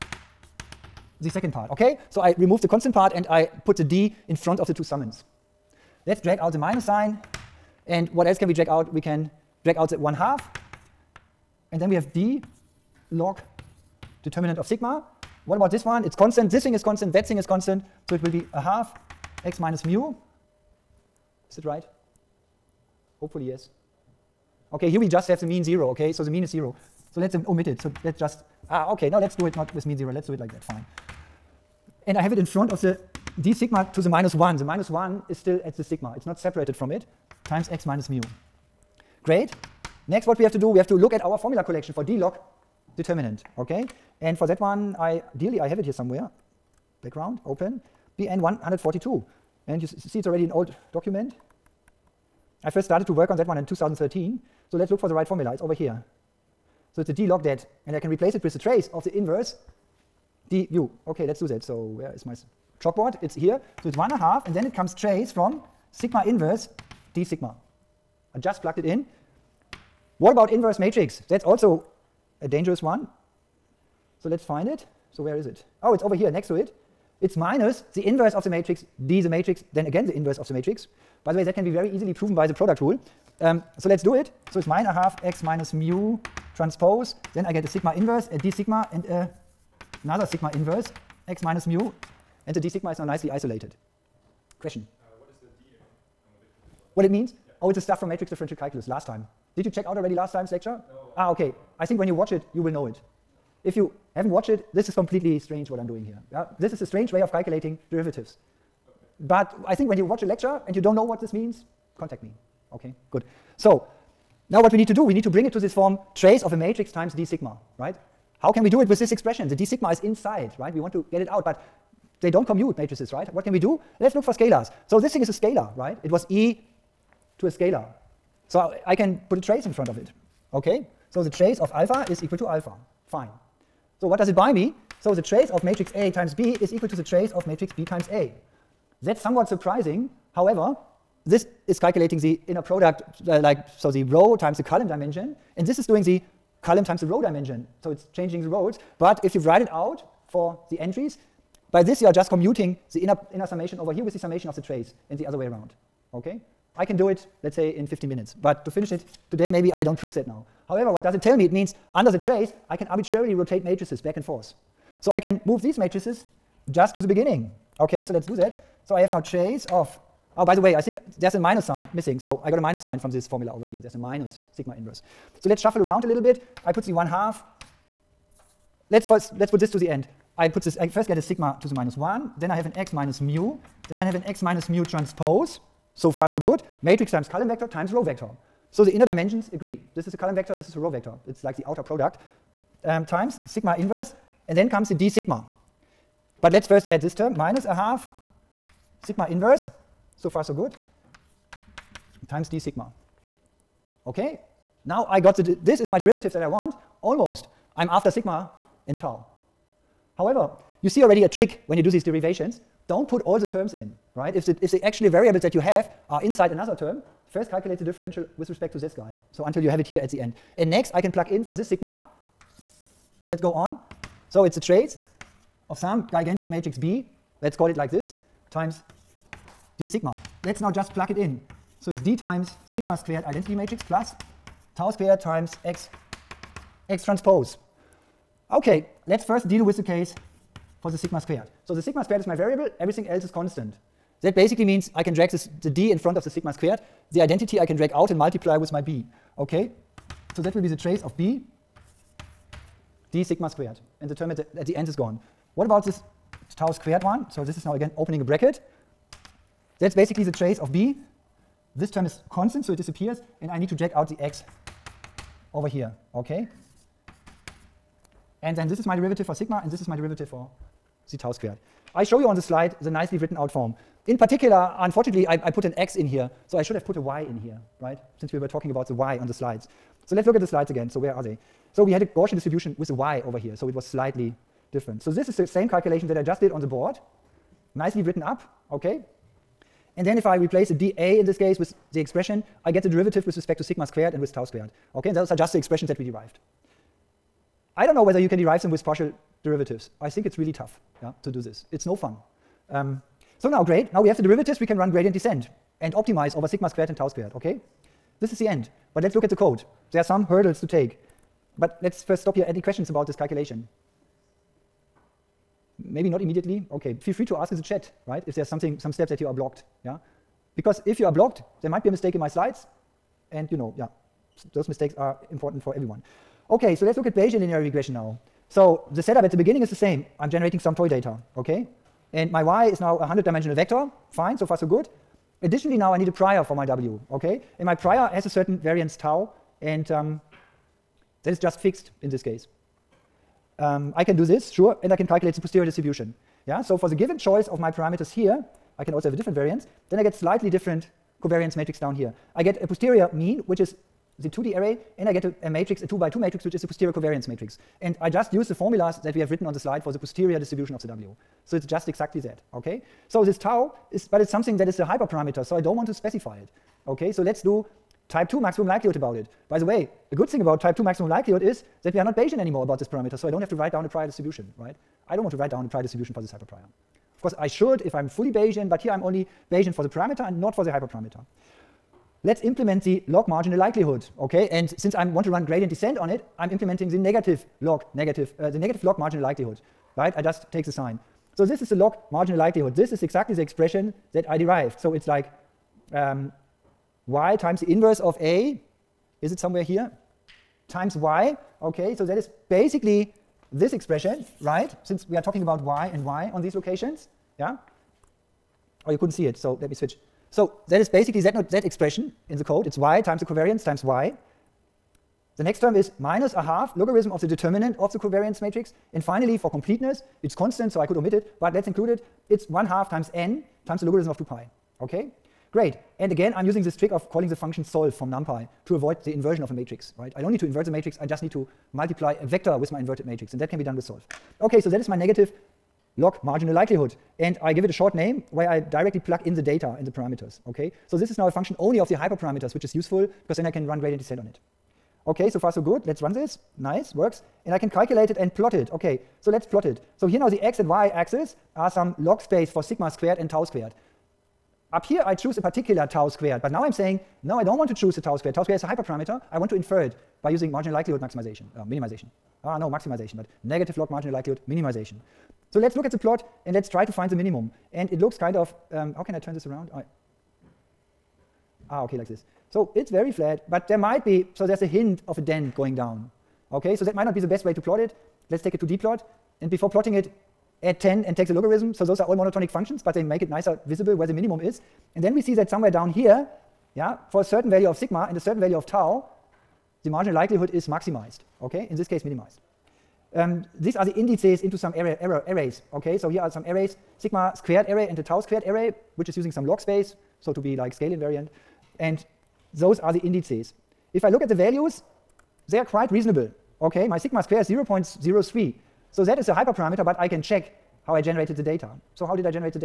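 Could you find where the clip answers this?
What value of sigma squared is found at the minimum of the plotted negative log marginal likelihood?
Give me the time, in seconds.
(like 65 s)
507 s.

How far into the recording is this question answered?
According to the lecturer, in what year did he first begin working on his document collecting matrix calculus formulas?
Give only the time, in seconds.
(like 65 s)
53 s.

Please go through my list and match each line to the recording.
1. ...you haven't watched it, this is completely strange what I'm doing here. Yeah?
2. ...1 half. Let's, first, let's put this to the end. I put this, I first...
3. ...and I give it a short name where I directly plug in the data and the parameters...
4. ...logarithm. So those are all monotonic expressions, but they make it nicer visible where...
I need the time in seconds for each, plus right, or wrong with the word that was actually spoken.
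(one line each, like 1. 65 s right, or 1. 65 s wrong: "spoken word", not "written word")
1. 103 s right
2. 176 s right
3. 437 s right
4. 481 s wrong: "functions", not "expressions".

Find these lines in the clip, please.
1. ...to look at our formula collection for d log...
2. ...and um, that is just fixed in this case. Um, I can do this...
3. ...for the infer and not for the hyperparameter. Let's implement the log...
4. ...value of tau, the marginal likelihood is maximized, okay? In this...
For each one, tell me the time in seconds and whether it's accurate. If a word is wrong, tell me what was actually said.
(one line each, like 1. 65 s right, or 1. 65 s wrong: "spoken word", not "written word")
1. 40 s right
2. 339 s right
3. 379 s wrong: "parameter", not "infer"
4. 488 s right.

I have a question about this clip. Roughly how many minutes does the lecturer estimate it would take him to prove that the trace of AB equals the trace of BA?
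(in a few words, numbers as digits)
15.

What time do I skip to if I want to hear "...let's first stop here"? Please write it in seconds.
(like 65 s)
311 s.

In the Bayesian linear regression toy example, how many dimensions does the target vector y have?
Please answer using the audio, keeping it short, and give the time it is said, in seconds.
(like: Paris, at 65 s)
100, at 333 s.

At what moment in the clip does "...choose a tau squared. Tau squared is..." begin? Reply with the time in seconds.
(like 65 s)
457 s.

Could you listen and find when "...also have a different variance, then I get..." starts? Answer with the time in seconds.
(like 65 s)
348 s.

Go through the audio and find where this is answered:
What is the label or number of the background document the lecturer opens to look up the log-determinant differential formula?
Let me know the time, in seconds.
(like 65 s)
48 s.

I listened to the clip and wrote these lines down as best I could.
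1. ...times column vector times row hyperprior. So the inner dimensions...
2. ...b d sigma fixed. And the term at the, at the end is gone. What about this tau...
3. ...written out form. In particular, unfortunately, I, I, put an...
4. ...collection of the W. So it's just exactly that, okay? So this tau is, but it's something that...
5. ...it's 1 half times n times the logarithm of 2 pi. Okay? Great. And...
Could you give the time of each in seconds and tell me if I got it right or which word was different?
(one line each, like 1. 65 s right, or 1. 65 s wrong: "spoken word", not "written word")
1. 187 s wrong: "vector", not "hyperprior"
2. 251 s wrong: "squared", not "fixed"
3. 273 s right
4. 360 s wrong: "distribution", not "collection"
5. 422 s right.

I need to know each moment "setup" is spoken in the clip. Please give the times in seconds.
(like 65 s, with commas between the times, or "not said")
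329 s.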